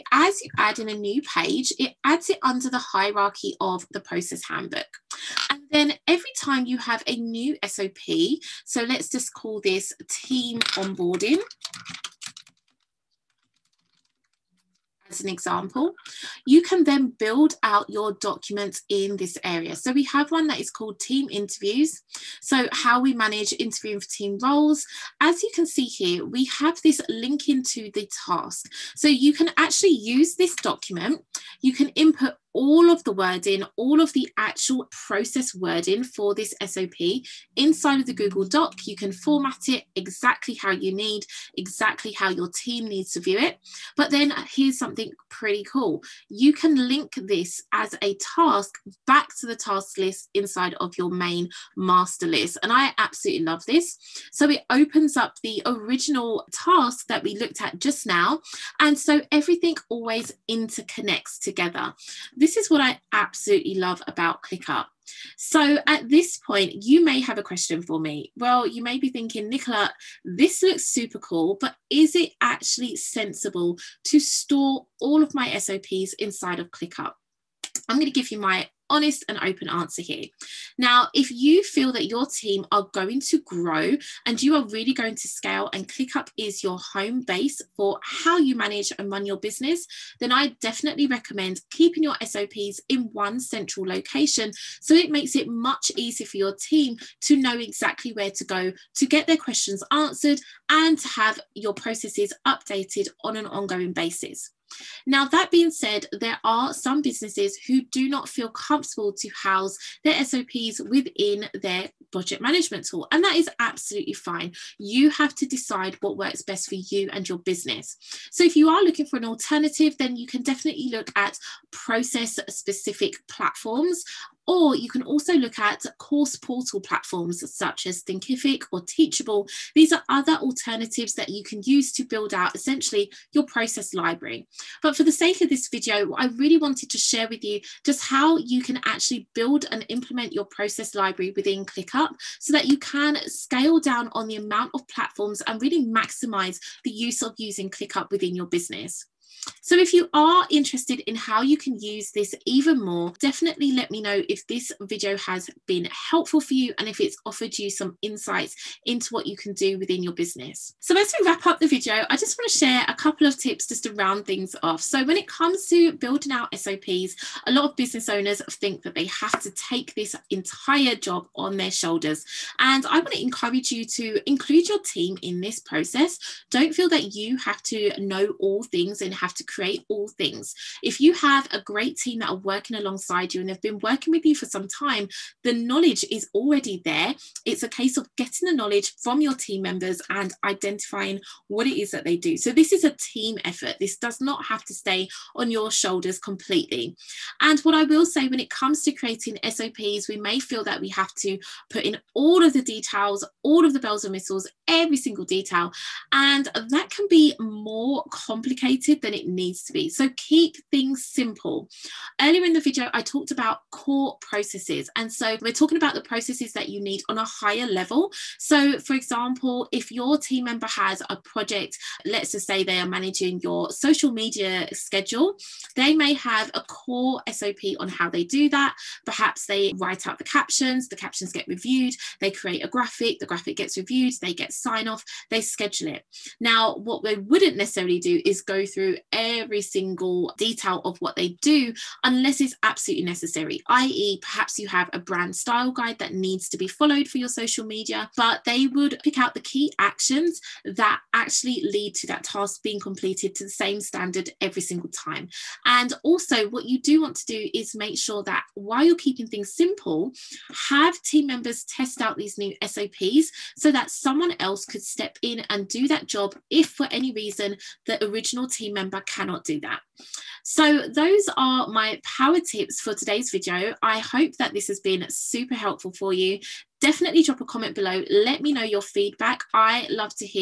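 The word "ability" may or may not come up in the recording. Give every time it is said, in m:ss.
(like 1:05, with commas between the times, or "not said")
not said.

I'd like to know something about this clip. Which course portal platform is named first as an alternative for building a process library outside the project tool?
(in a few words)
Thinkific.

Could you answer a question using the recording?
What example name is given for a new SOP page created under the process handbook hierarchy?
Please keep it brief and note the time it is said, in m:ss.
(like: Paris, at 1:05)
Team onboarding, at 0:10.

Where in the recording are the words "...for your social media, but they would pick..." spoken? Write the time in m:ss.
4:07.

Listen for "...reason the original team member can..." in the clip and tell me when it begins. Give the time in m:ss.
4:27.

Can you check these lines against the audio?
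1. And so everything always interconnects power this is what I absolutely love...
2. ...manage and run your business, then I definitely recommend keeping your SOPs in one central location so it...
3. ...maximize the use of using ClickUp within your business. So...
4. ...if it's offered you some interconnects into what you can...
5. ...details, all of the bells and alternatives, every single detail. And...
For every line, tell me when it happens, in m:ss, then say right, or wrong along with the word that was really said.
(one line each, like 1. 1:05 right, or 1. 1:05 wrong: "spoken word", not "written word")
1. 0:58 wrong: "together", not "power"
2. 1:28 right
3. 2:25 right
4. 2:36 wrong: "insights", not "interconnects"
5. 3:22 wrong: "whistles", not "alternatives".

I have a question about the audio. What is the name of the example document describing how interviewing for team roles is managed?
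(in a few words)
Team interviews.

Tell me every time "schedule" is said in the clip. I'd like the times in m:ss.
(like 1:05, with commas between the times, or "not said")
3:44, 3:55.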